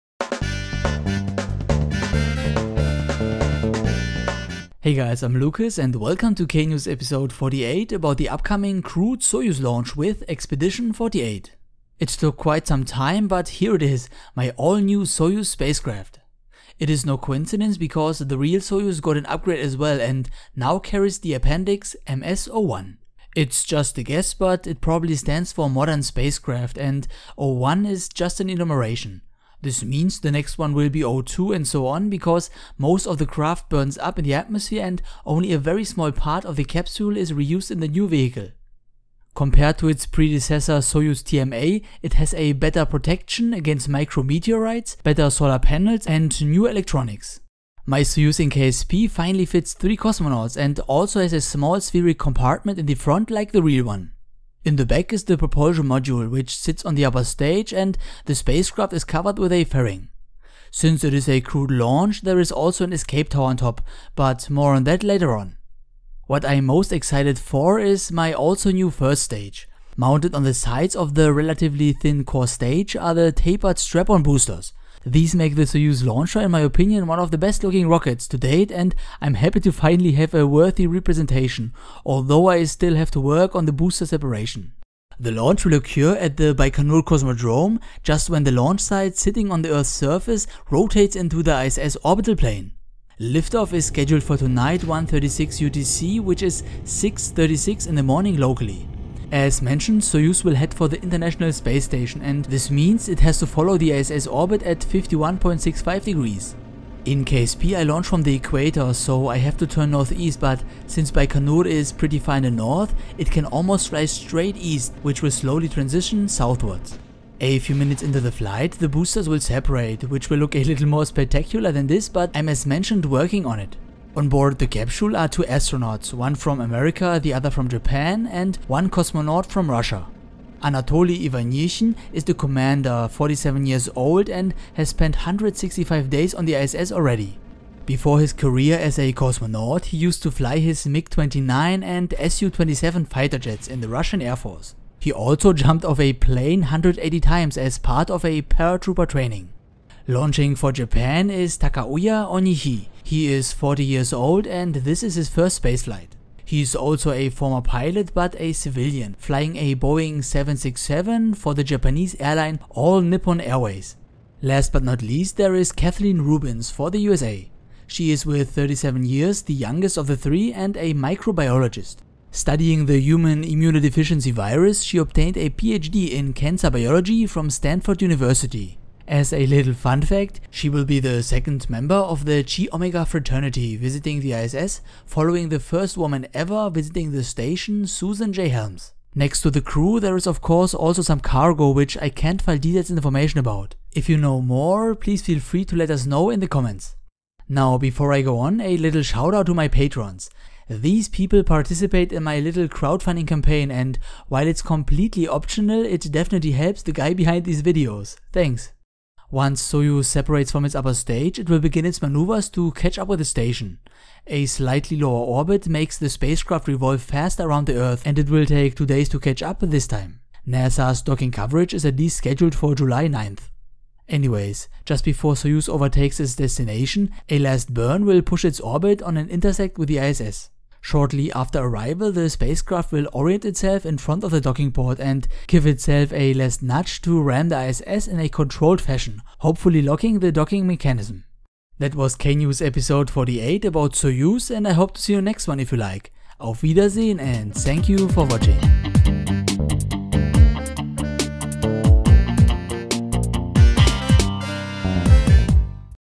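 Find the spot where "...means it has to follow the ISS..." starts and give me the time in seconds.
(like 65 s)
102 s.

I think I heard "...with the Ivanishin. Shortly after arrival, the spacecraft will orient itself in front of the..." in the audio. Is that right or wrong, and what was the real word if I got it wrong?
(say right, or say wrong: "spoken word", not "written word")
wrong: "ISS", not "Ivanishin".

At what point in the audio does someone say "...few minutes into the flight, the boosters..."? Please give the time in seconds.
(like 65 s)
117 s.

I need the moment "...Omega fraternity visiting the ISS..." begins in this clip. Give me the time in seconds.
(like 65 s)
182 s.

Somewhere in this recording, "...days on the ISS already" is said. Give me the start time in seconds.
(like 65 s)
136 s.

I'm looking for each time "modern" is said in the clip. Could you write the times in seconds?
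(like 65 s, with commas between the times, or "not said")
25 s.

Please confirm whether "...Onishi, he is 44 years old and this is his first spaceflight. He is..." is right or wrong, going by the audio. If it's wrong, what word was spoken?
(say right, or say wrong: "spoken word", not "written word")
wrong: "40", not "44".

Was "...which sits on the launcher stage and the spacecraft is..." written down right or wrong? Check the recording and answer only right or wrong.
wrong.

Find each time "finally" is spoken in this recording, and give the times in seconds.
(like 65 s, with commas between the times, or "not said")
49 s, 79 s.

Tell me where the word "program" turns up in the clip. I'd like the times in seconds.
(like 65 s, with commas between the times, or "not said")
not said.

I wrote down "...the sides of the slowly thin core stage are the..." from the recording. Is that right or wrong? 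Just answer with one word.
wrong.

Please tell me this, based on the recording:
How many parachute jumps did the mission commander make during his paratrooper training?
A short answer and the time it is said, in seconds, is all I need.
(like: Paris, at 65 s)
180, at 146 s.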